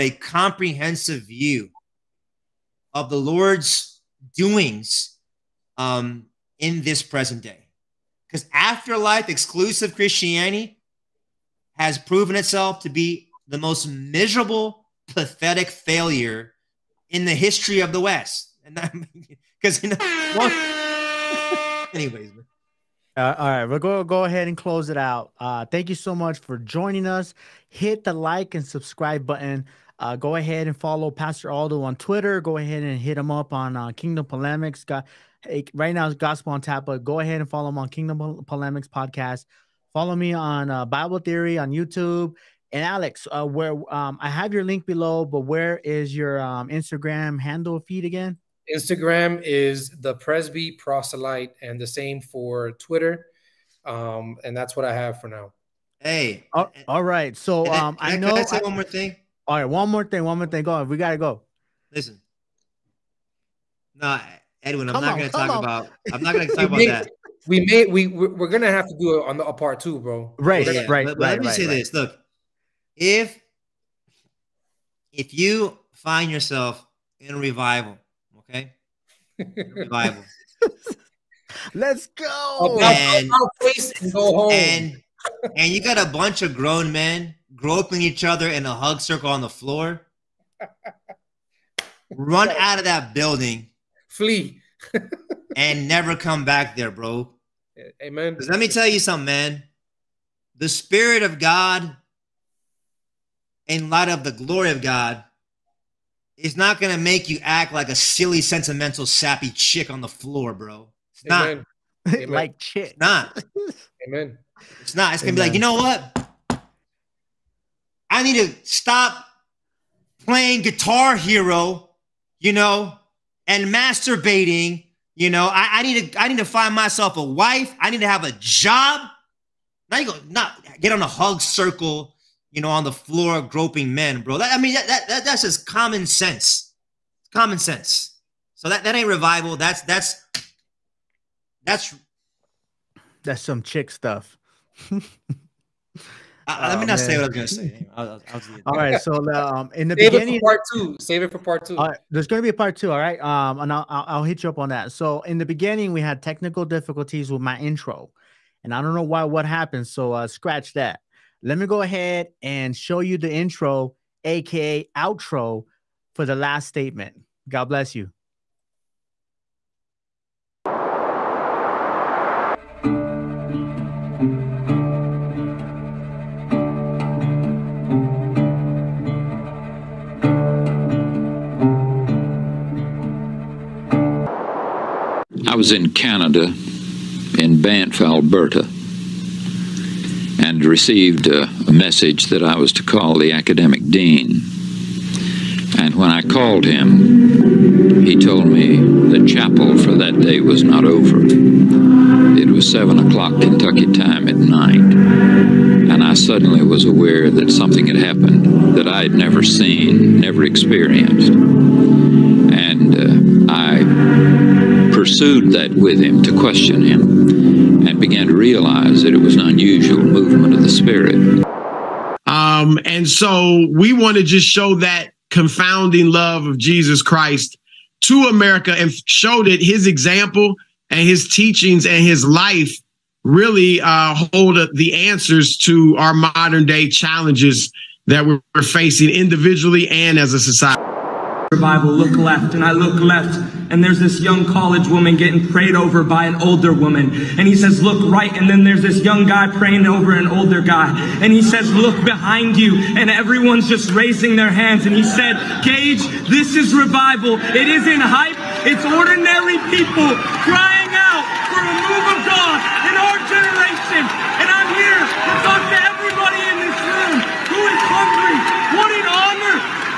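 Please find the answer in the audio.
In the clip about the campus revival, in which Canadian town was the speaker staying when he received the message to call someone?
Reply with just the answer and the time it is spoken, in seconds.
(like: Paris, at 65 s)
Banff, Alberta, at 187 s.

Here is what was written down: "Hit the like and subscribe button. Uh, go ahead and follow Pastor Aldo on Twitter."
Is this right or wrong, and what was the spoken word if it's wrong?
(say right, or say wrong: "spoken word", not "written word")
right.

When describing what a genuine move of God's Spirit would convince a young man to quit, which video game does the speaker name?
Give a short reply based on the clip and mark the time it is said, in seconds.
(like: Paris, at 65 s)
Guitar Hero, at 120 s.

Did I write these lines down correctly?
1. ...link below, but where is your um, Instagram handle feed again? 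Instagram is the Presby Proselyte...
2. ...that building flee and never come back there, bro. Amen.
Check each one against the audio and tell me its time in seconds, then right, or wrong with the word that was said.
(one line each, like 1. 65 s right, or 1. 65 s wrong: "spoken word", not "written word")
1. 44 s right
2. 92 s right.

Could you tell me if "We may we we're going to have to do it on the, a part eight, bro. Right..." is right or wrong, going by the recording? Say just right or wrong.
wrong.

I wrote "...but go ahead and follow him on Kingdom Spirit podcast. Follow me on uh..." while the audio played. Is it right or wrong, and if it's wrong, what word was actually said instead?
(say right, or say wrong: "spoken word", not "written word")
wrong: "Polemics", not "Spirit".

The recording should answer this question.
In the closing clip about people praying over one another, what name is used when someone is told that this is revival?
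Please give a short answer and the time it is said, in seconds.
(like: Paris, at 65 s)
Gage, at 255 s.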